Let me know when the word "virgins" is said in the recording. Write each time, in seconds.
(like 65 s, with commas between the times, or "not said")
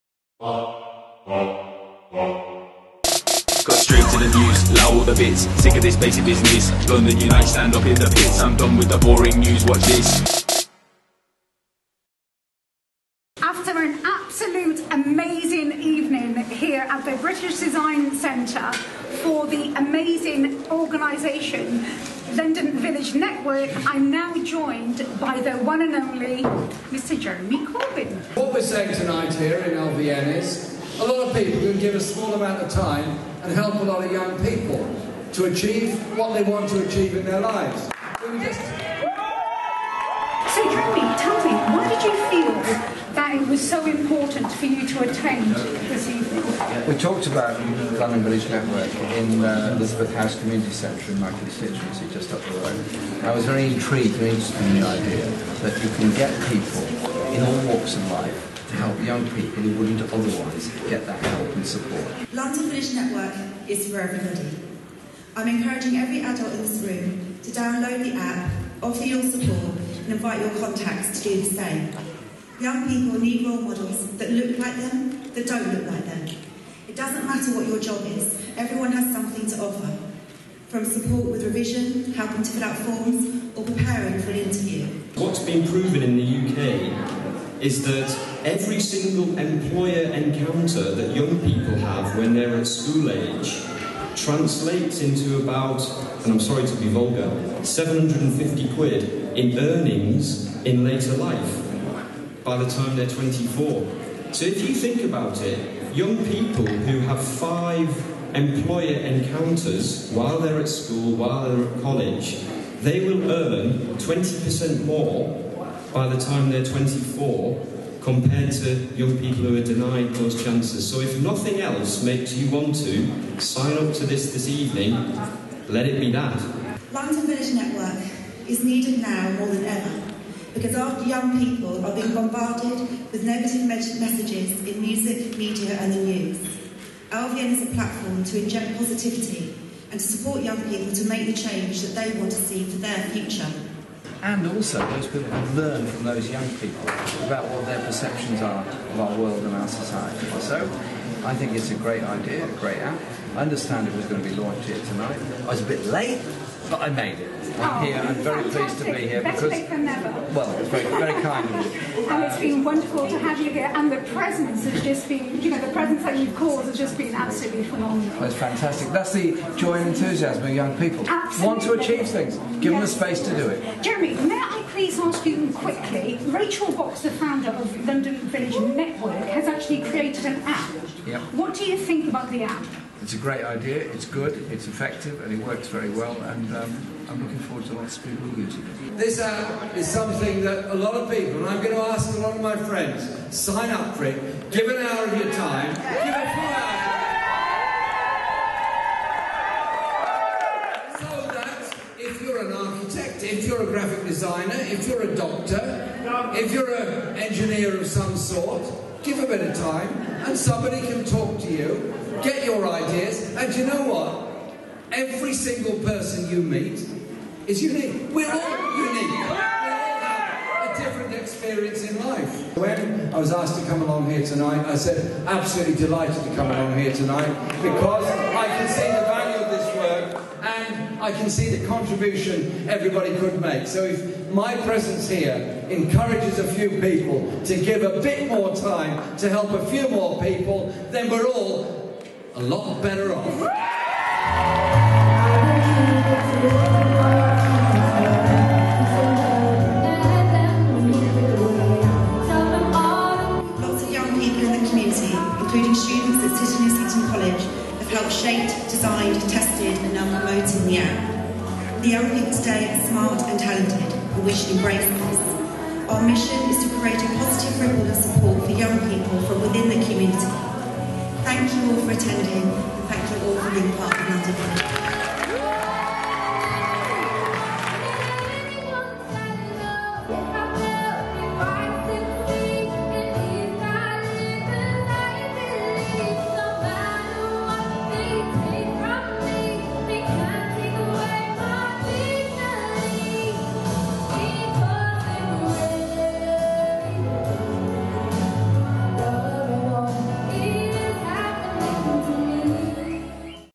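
not said.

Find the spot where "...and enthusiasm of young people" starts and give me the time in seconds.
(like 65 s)
169 s.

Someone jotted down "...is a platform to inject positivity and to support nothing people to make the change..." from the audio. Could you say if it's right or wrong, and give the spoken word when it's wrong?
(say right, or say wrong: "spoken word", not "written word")
wrong: "young", not "nothing".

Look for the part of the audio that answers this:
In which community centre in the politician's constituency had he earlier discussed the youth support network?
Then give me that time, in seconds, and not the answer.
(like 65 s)
49 s.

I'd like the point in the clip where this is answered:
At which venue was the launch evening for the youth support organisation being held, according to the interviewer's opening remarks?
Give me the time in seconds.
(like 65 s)
17 s.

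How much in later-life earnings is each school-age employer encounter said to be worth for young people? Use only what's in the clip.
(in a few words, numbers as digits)
£750.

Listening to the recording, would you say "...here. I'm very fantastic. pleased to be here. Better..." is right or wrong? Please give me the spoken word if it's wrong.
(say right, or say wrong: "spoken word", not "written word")
right.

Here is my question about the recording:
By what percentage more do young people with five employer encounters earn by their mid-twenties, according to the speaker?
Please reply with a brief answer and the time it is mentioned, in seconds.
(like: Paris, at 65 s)
20%, at 113 s.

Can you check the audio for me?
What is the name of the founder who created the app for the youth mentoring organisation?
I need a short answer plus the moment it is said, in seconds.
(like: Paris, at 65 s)
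Rachel Box, at 176 s.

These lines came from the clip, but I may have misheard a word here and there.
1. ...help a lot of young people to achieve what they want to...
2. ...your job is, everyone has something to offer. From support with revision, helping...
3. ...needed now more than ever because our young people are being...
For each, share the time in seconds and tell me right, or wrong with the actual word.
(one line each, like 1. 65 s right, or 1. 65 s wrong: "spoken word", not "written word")
1. 33 s right
2. 77 s right
3. 128 s right.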